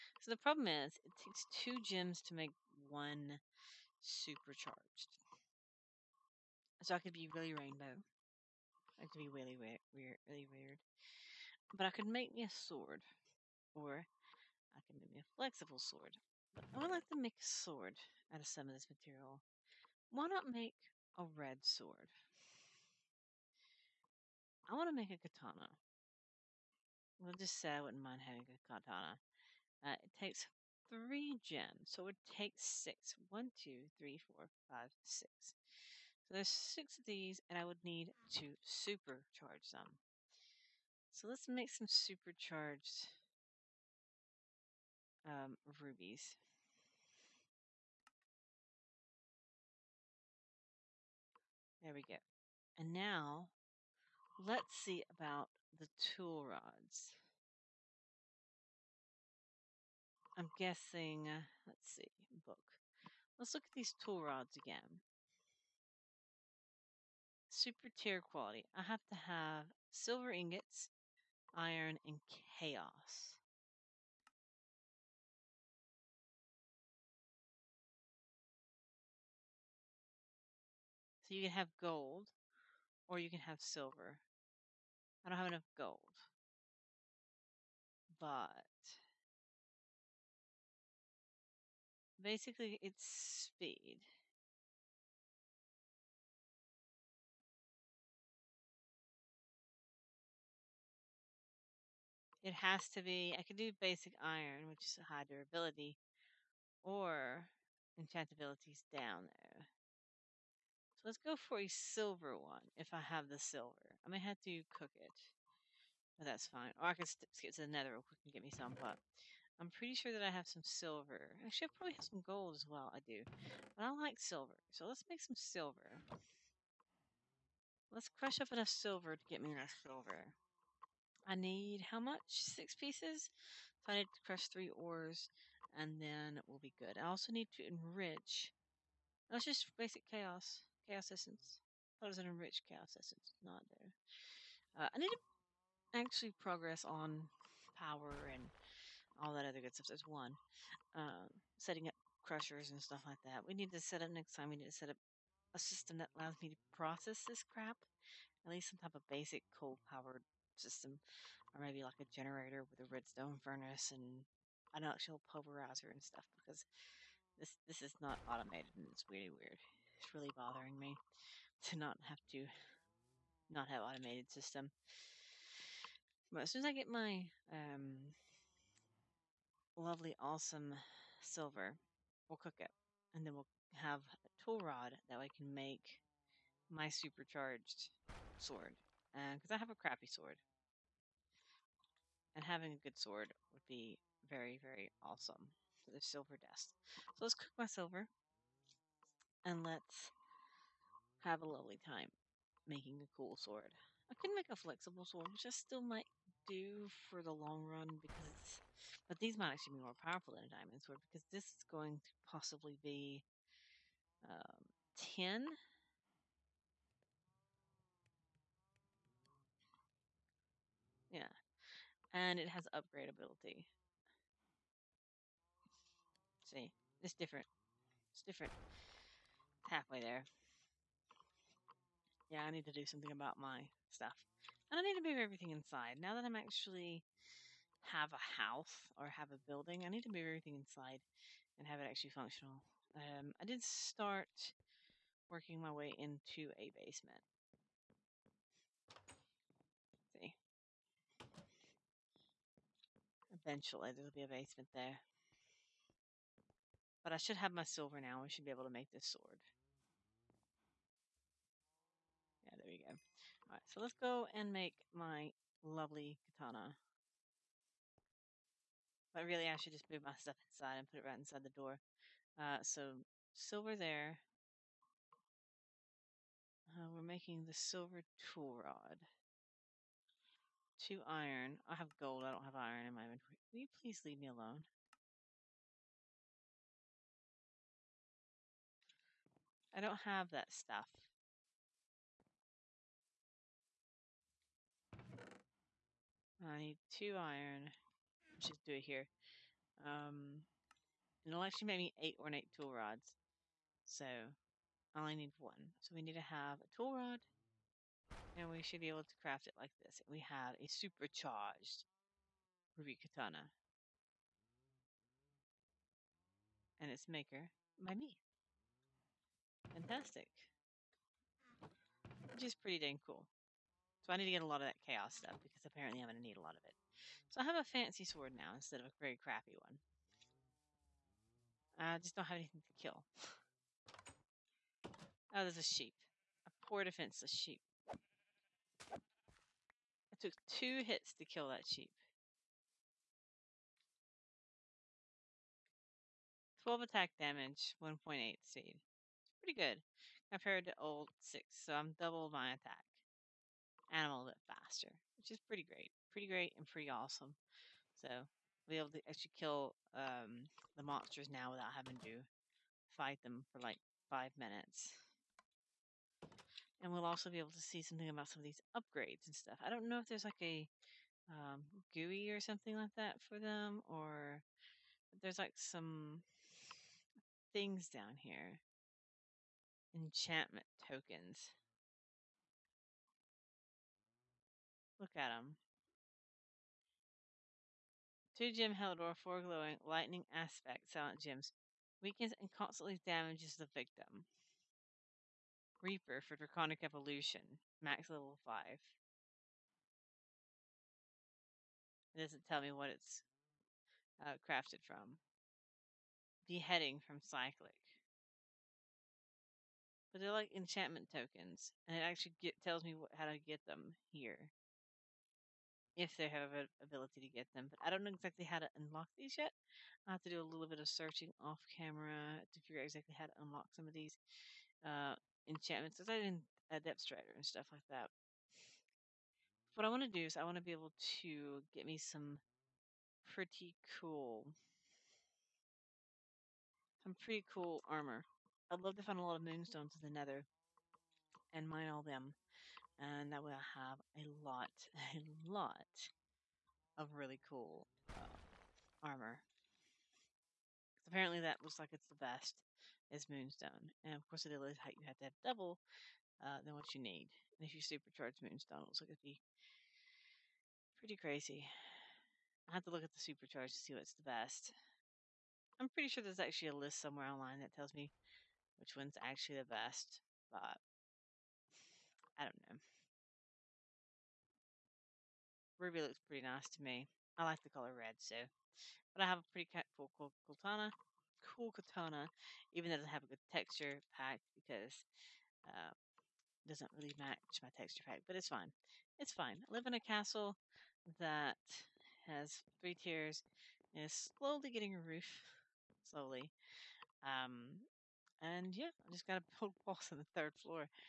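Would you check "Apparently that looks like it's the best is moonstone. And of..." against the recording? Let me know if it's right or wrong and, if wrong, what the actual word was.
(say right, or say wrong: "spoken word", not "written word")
right.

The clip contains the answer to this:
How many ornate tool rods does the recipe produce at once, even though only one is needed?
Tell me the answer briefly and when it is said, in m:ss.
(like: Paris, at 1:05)
8, at 5:01.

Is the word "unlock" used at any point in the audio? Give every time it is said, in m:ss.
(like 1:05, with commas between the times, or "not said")
6:58, 7:03.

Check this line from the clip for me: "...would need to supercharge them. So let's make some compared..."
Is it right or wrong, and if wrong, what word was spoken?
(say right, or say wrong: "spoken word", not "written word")
wrong: "supercharged", not "compared".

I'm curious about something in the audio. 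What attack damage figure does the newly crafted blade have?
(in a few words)
12.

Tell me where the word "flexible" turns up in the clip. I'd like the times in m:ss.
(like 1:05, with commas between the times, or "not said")
0:15, 3:24.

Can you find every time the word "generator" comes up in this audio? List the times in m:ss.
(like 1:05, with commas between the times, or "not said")
2:42.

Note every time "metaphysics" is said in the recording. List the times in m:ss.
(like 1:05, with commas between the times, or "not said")
not said.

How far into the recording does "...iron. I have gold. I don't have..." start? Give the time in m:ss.
4:41.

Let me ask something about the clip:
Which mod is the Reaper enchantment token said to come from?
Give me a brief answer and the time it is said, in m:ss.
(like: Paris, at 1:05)
Draconic Evolution, at 6:36.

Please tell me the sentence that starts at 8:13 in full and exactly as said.
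and Is slowly getting a roof, slowly.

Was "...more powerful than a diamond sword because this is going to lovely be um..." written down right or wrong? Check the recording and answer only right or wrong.
wrong.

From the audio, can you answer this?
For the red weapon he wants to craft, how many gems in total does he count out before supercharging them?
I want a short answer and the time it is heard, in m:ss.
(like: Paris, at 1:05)
6, at 0:31.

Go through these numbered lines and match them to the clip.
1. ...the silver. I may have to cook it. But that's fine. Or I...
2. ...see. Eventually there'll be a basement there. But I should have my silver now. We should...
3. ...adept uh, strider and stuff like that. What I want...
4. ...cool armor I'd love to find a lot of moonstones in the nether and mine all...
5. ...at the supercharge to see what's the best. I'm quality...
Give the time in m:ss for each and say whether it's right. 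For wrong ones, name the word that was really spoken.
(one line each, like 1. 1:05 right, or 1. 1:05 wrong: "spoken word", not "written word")
1. 1:53 right
2. 4:10 right
3. 7:06 right
4. 7:17 right
5. 7:43 wrong: "pretty", not "quality".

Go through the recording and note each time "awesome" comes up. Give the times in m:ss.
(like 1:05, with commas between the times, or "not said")
3:00, 3:14, 5:56.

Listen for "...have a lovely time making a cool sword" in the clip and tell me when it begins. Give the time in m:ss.
3:21.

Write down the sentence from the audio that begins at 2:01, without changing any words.
Actually, I probably have some gold as well.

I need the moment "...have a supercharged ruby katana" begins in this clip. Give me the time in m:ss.
5:10.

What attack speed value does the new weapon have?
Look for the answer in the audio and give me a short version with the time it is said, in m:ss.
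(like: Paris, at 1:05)
1.8, at 5:47.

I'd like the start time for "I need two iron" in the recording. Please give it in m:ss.
4:56.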